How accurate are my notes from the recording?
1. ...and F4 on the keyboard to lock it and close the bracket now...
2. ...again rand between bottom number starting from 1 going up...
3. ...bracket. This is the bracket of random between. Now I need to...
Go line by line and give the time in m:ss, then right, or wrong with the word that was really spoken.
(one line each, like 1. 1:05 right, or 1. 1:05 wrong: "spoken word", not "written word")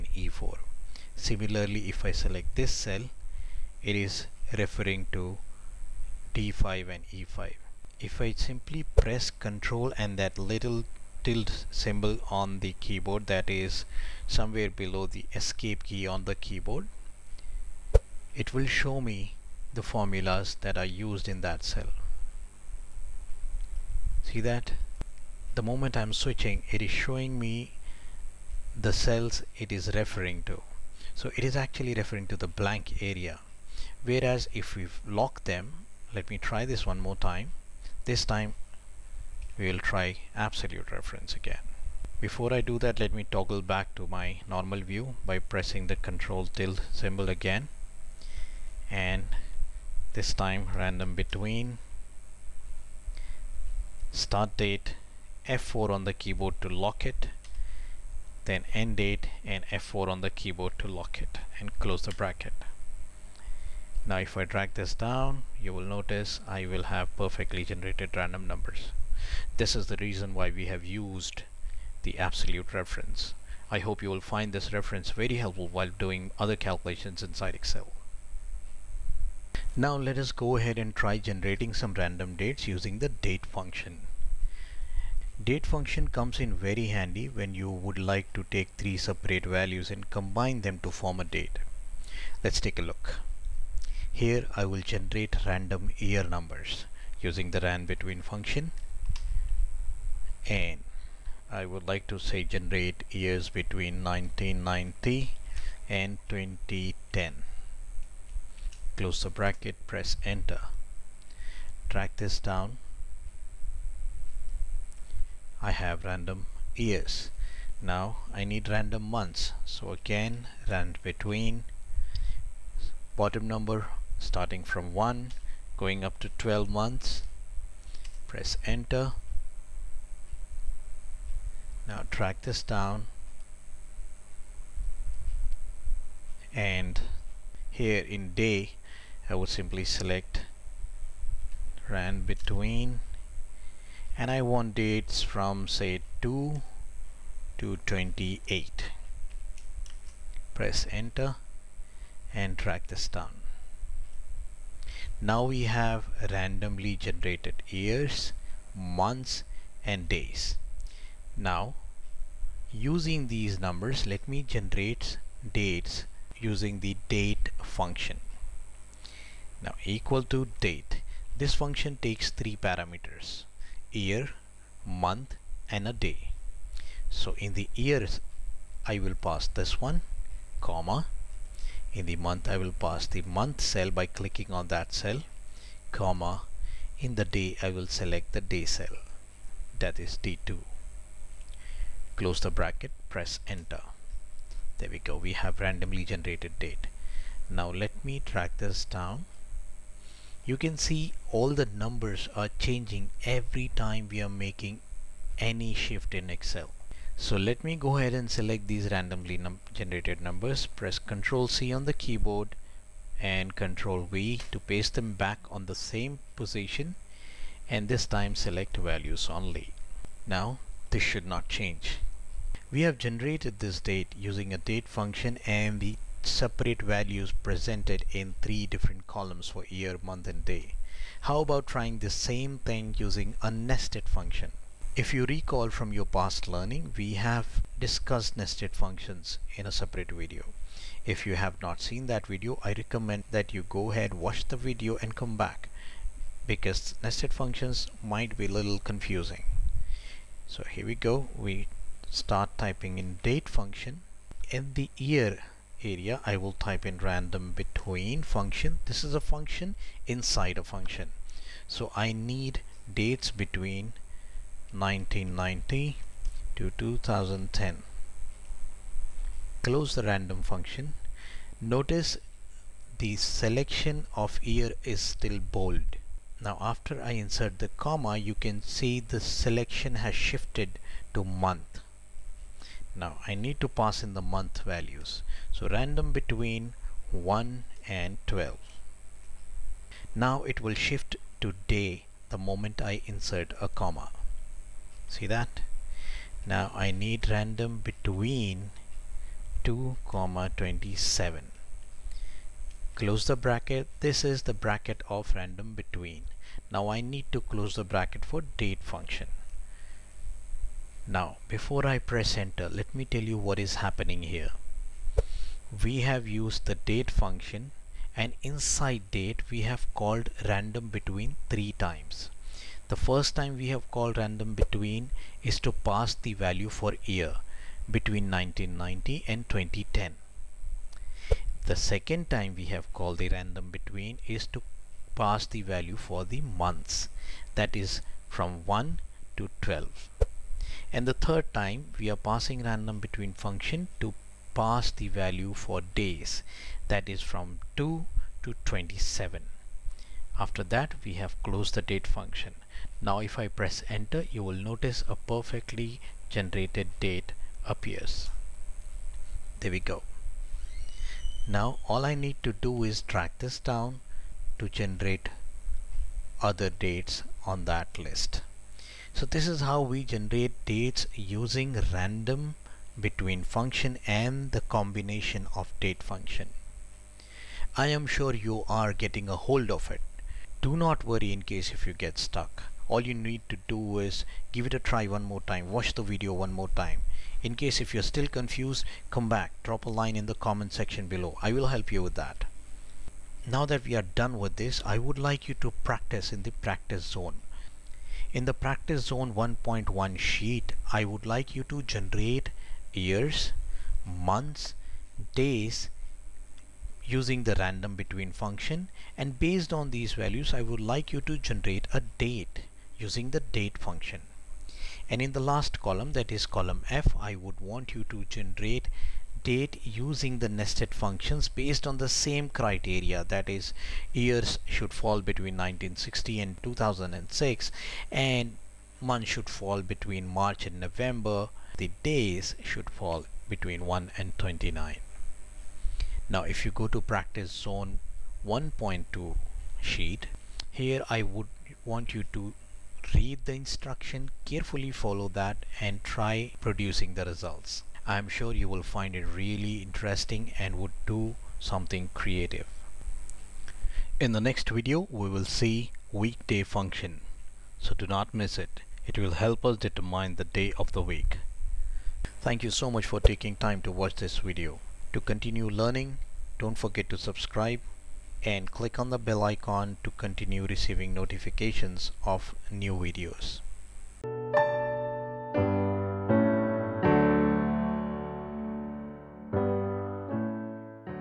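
1. 0:59 right
2. 1:59 right
3. 5:03 right.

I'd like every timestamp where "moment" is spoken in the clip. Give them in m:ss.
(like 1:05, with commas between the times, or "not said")
0:25, 4:52.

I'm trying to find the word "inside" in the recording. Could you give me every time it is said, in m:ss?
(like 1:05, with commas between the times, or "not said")
1:17, 4:20, 5:18.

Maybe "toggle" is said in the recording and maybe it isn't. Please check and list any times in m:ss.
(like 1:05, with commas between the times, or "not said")
0:43.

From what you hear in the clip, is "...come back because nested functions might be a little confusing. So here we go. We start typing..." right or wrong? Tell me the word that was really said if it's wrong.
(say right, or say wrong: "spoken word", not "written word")
right.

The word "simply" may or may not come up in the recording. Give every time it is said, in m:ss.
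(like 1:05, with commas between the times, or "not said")
0:08, 2:19.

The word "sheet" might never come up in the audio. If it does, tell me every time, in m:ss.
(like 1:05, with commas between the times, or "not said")
6:40, 7:19.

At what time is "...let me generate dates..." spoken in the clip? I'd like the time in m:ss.
2:44.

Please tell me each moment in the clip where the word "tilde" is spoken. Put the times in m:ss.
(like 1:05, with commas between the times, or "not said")
0:11, 0:46.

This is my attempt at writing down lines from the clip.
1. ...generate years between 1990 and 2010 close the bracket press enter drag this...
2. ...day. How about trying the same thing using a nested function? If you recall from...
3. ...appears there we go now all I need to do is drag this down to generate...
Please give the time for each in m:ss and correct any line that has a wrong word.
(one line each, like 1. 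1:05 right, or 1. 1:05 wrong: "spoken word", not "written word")
1. 1:42 right
2. 3:50 right
3. 5:57 right.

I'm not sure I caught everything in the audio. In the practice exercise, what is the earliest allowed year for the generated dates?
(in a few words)
1960.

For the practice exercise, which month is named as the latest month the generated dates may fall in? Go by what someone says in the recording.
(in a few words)
November.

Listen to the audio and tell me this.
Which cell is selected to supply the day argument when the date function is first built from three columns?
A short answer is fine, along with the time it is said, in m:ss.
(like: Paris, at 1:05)
D2, at 3:10.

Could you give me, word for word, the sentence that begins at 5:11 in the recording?
Now before I press enter let me tell you what is happening here.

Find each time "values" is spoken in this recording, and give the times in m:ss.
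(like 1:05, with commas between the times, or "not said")
1:29, 3:38, 3:46, 4:44, 5:26, 5:35, 5:45, 6:50.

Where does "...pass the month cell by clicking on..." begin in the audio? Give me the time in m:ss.
3:02.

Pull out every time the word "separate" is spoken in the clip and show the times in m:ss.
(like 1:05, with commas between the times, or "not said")
1:28, 3:46, 3:59.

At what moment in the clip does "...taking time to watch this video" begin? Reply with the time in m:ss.
7:43.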